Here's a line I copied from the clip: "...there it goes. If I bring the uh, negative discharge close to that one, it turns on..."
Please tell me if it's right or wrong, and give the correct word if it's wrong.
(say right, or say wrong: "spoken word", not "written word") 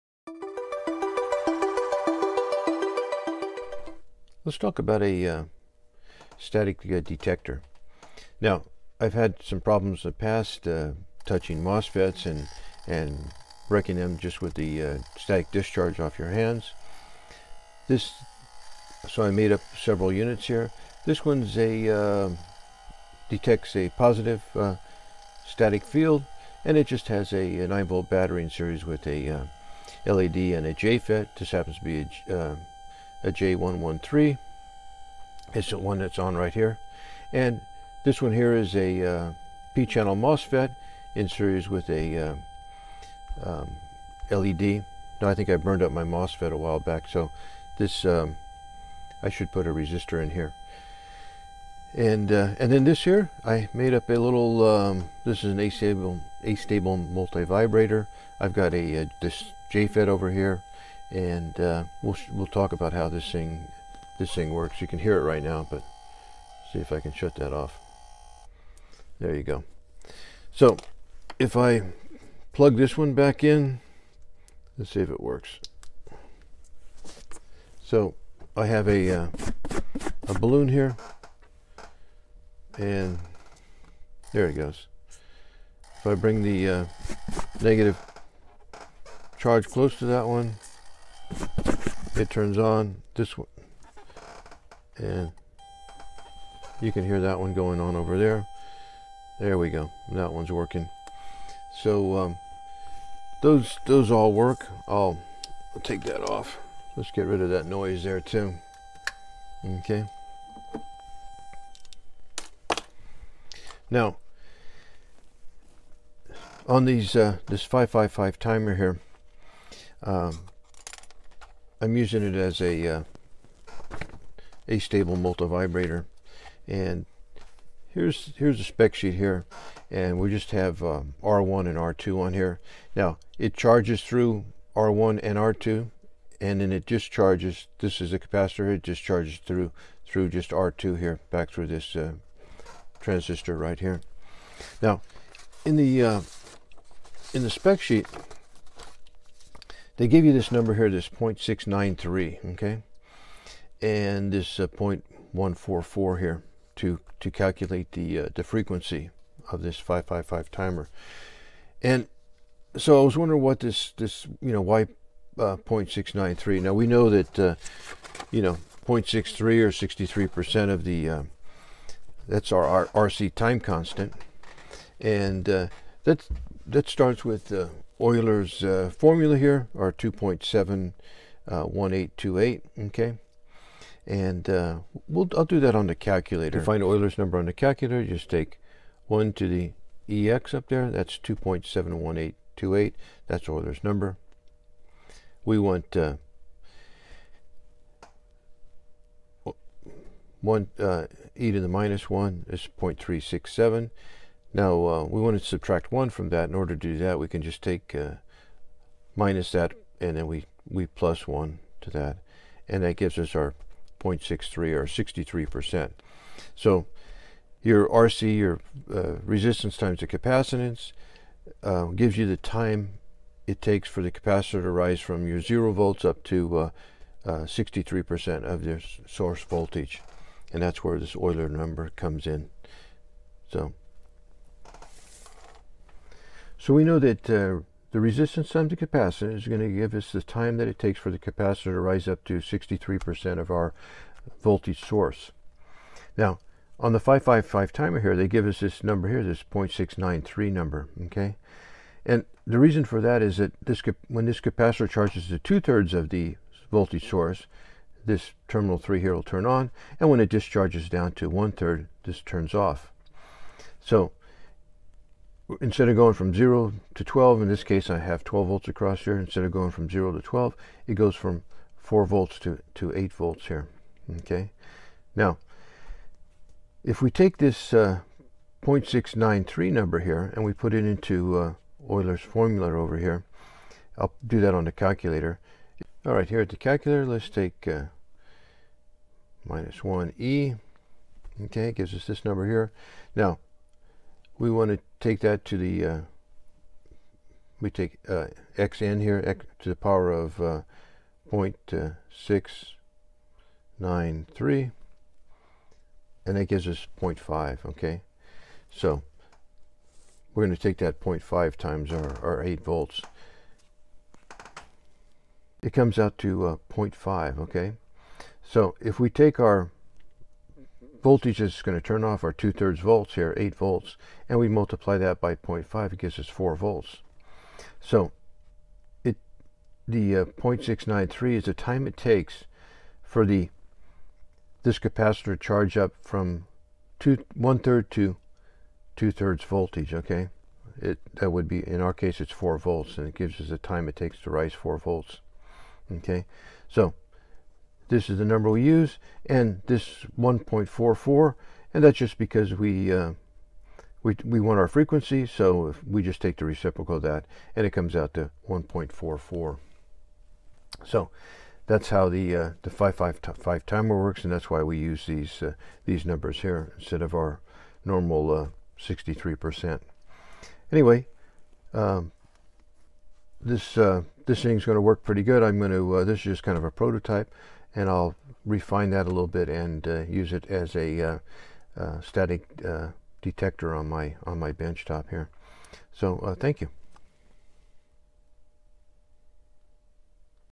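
wrong: "charge", not "discharge".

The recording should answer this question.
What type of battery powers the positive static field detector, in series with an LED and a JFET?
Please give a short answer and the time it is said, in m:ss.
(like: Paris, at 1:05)
9 volt, at 0:27.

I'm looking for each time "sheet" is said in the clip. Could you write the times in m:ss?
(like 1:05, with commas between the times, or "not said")
2:08, 2:27.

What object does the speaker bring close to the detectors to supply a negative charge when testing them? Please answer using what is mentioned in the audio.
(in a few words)
a balloon.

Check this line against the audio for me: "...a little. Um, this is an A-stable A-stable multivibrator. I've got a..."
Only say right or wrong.
right.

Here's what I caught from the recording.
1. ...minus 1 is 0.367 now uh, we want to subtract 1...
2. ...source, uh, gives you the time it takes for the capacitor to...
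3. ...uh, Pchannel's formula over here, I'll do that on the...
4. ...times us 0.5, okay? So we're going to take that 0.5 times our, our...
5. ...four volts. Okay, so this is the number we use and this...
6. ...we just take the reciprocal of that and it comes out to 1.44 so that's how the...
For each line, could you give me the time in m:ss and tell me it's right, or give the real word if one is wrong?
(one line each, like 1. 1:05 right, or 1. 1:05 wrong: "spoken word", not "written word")
1. 3:21 right
2. 3:40 wrong: "capacitance", not "source"
3. 4:41 wrong: "Euler", not "Pchannel"
4. 5:06 wrong: "gives", not "times"
5. 5:44 right
6. 5:55 right.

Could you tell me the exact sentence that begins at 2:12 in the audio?
Now it charges through R1 and R2, and then it discharges.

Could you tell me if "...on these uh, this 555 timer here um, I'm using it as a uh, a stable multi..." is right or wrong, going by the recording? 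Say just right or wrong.
right.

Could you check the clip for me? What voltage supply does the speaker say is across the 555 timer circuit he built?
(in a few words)
12 volts.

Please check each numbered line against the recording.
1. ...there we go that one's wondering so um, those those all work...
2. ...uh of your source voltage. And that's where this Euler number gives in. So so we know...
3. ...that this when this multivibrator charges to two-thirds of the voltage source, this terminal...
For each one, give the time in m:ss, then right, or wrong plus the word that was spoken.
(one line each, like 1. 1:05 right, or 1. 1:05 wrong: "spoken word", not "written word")
1. 1:39 wrong: "working", not "wondering"
2. 3:48 wrong: "comes", not "gives"
3. 4:13 wrong: "capacitor", not "multivibrator".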